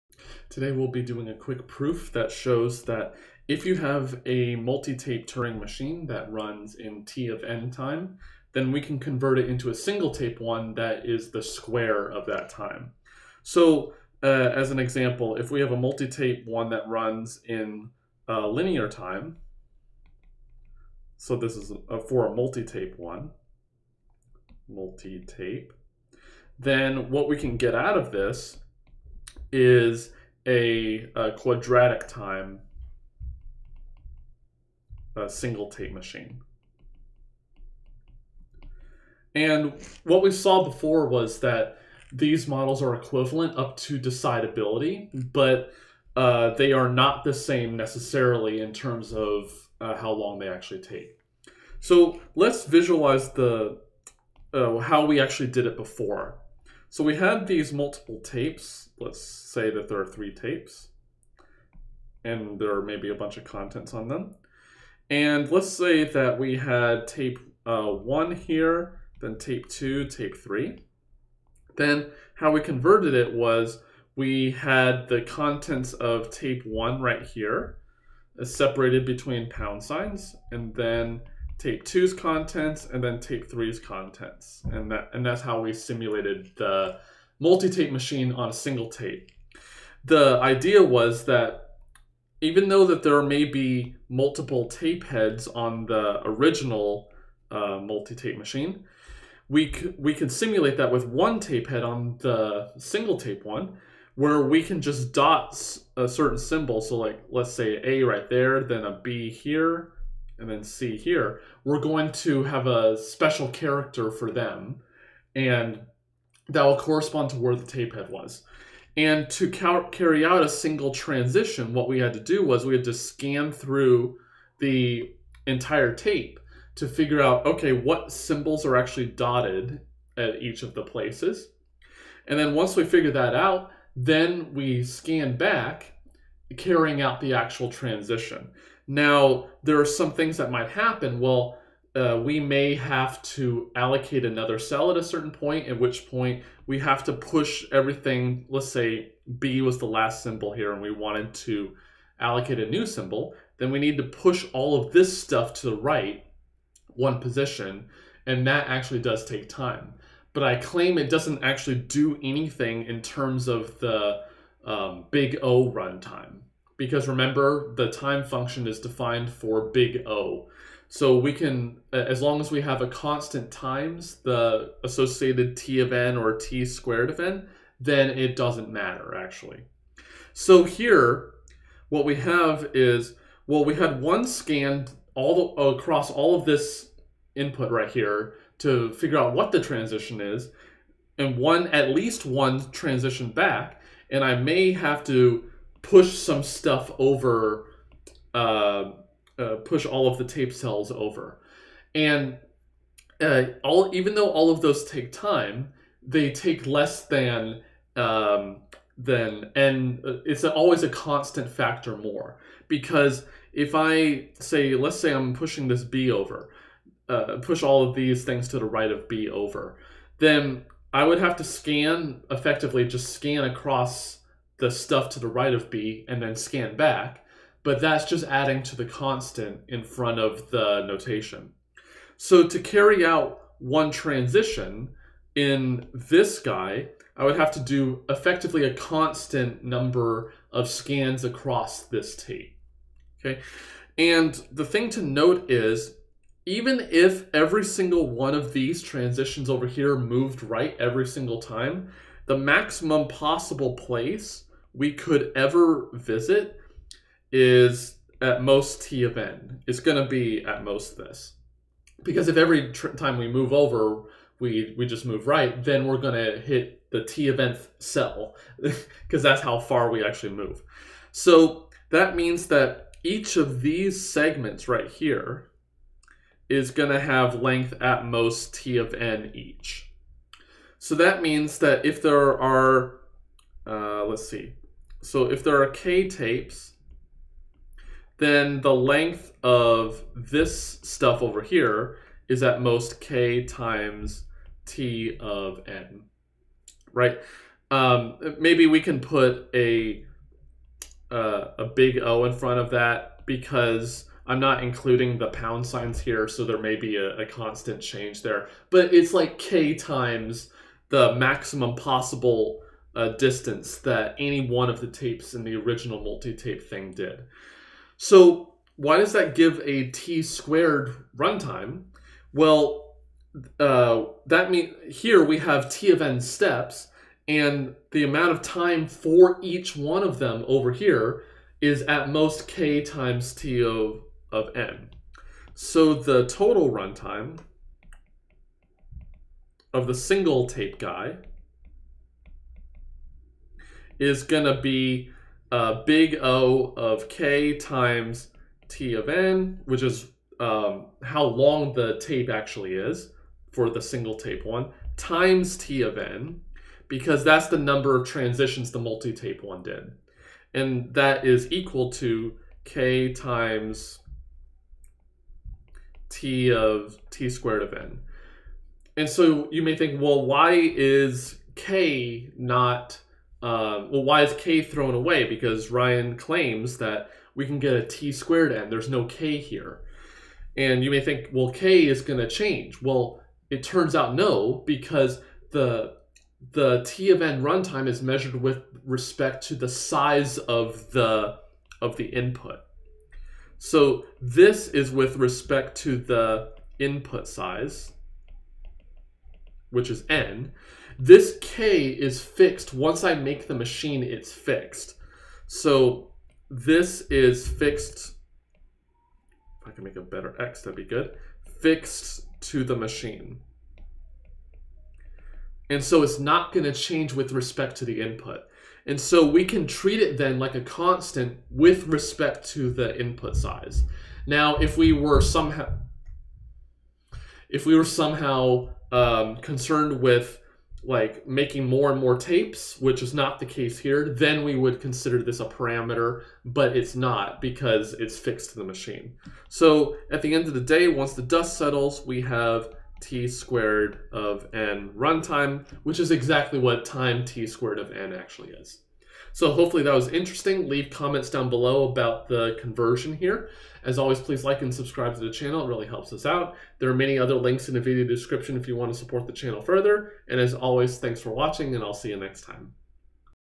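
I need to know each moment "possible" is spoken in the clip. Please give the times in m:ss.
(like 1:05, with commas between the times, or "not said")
4:13, 5:11.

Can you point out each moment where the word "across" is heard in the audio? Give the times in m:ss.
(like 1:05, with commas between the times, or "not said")
3:05, 3:43, 4:01.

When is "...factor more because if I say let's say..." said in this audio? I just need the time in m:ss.
3:31.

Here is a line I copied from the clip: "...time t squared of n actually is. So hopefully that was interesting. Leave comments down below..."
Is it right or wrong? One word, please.
right.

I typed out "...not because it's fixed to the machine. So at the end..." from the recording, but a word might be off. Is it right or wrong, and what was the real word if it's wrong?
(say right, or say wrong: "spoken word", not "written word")
right.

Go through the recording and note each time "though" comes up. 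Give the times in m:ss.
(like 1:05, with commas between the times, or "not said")
1:32, 3:24.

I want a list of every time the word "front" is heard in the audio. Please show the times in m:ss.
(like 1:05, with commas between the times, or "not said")
3:49, 5:02.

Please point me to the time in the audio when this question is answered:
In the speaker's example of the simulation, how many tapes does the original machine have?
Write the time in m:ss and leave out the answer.
1:00.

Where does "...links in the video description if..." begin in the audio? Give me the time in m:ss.
7:37.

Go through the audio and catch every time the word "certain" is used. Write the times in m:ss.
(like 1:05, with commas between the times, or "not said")
1:46, 2:25.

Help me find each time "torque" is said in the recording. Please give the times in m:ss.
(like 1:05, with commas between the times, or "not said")
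not said.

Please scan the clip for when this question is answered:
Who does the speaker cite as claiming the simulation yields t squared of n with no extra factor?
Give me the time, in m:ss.
6:15.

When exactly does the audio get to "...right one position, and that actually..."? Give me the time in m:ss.
2:35.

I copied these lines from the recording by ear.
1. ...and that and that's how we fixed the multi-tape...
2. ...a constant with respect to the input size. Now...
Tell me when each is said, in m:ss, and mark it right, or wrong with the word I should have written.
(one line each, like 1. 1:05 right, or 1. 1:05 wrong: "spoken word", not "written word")
1. 1:24 wrong: "simulated", not "fixed"
2. 7:00 right.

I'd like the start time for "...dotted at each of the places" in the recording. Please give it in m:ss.
2:09.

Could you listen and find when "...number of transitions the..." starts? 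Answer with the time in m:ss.
5:57.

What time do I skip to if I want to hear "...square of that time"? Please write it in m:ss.
0:11.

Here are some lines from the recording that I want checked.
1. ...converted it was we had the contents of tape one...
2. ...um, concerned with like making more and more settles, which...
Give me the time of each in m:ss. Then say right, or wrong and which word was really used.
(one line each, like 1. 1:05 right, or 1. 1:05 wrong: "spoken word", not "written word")
1. 1:12 right
2. 7:08 wrong: "tapes", not "settles".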